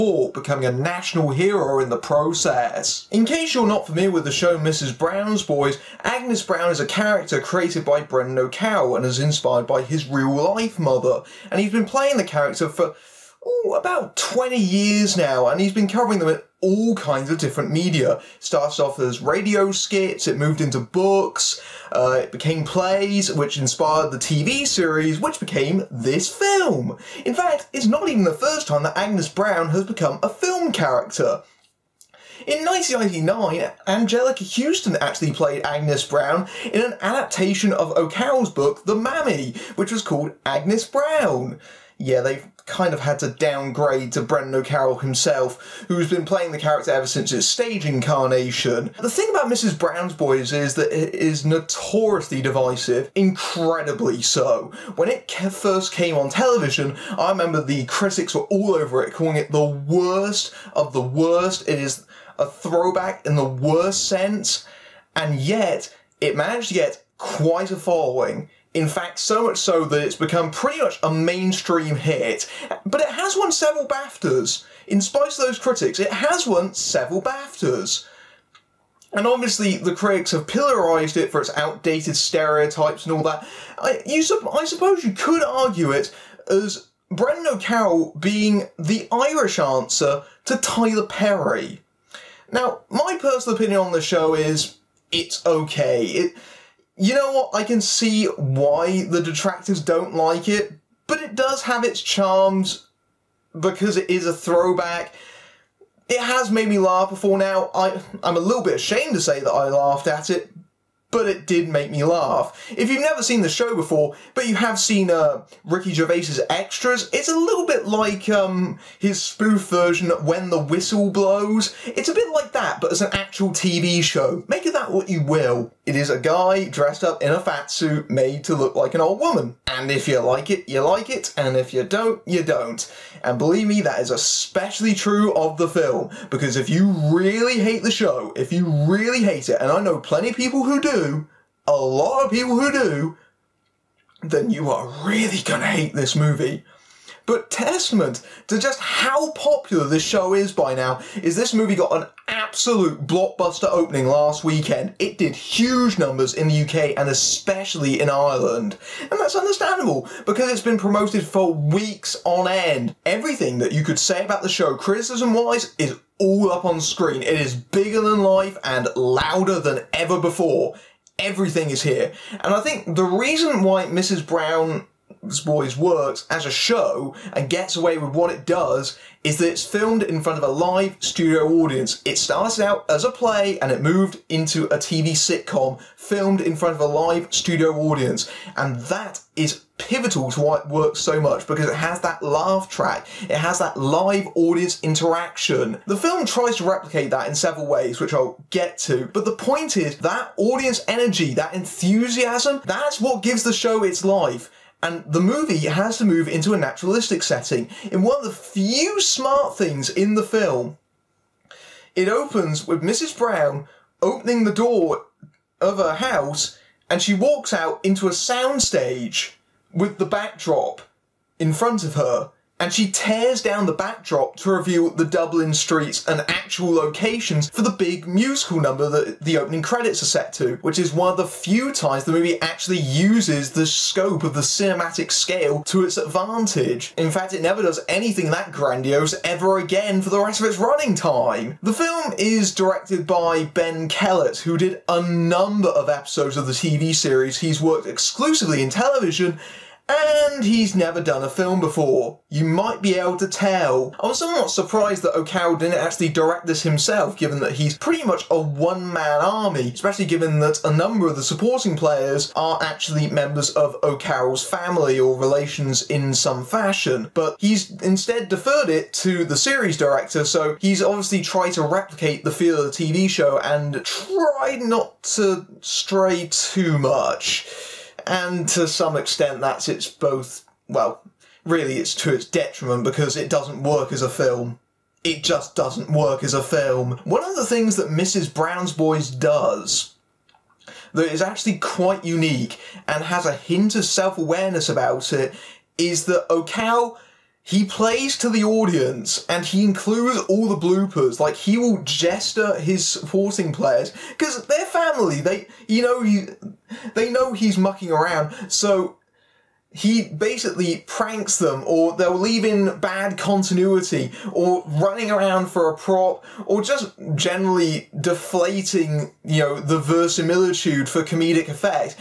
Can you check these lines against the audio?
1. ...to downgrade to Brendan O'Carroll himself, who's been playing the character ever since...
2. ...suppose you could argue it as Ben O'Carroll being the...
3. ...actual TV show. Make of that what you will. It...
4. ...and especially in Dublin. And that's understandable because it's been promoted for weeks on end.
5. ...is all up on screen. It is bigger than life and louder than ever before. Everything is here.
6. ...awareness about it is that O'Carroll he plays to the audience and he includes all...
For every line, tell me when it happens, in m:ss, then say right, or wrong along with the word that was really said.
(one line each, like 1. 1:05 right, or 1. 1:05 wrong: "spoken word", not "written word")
1. 0:43 right
2. 1:24 wrong: "Brendan", not "Ben"
3. 2:03 right
4. 2:36 wrong: "Ireland", not "Dublin"
5. 2:45 right
6. 4:54 right.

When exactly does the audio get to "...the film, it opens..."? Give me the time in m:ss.
3:30.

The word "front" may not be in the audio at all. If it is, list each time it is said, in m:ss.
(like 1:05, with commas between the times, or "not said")
3:00, 3:06, 3:41.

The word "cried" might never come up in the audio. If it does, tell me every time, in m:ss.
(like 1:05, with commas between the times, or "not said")
not said.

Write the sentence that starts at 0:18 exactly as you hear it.
Started off as radio skits, it moved into books, uh, it became plays, which inspired the TV series, which became this film.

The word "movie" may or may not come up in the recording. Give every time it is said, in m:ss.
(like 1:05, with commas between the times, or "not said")
2:26, 2:31, 3:25, 3:52.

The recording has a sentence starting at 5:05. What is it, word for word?
They, you know, he, they know he's mucking around.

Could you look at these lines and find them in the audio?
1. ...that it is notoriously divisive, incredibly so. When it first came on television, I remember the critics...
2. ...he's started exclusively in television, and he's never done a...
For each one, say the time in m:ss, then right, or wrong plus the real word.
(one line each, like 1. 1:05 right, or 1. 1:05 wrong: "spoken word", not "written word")
1. 0:50 right
2. 4:07 wrong: "worked", not "started".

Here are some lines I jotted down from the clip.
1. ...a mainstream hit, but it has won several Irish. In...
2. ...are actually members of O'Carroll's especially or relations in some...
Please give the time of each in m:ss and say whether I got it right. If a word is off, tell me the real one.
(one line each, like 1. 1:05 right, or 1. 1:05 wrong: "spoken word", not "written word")
1. 1:11 wrong: "BAFTAs", not "Irish"
2. 4:22 wrong: "family", not "especially".